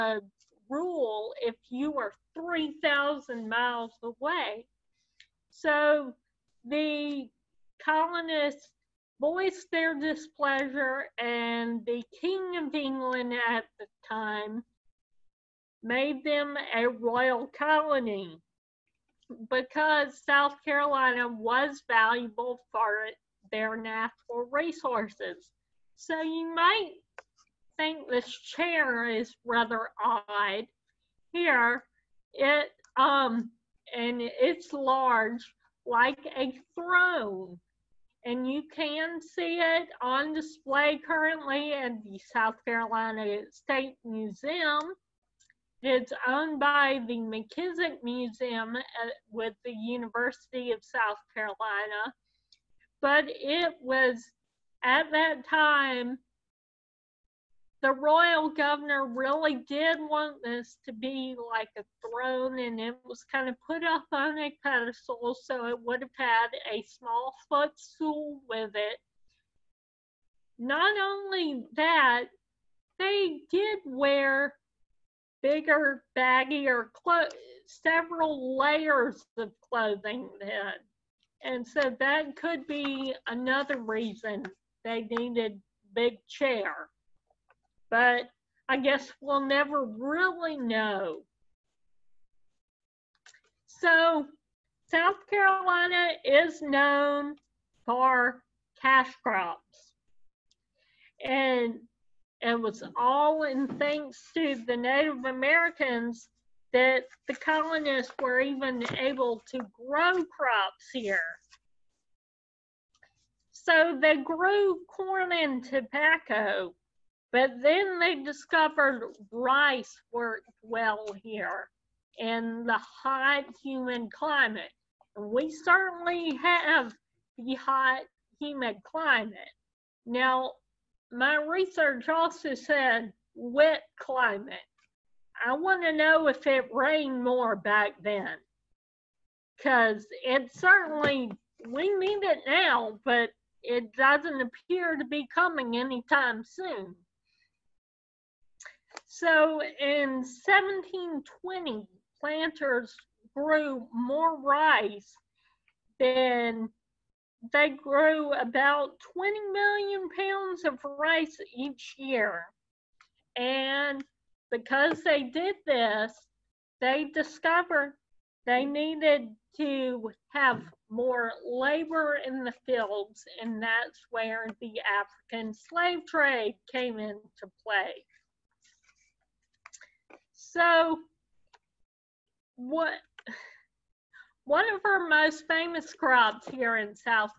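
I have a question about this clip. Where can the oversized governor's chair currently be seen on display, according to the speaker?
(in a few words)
South Carolina State Museum.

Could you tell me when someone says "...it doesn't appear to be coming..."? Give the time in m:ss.
2:23.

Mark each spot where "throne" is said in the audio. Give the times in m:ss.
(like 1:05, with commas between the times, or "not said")
0:36, 1:02.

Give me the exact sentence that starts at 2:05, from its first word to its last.
And we certainly have the hot, humid climate.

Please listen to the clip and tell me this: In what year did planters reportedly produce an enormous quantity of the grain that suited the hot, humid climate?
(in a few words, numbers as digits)
1720.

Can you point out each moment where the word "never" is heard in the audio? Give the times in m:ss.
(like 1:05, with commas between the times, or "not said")
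1:29.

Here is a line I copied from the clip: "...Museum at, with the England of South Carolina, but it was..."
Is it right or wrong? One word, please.
wrong.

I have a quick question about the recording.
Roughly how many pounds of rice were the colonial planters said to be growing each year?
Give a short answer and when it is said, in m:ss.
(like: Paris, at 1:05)
20 million pounds, at 2:39.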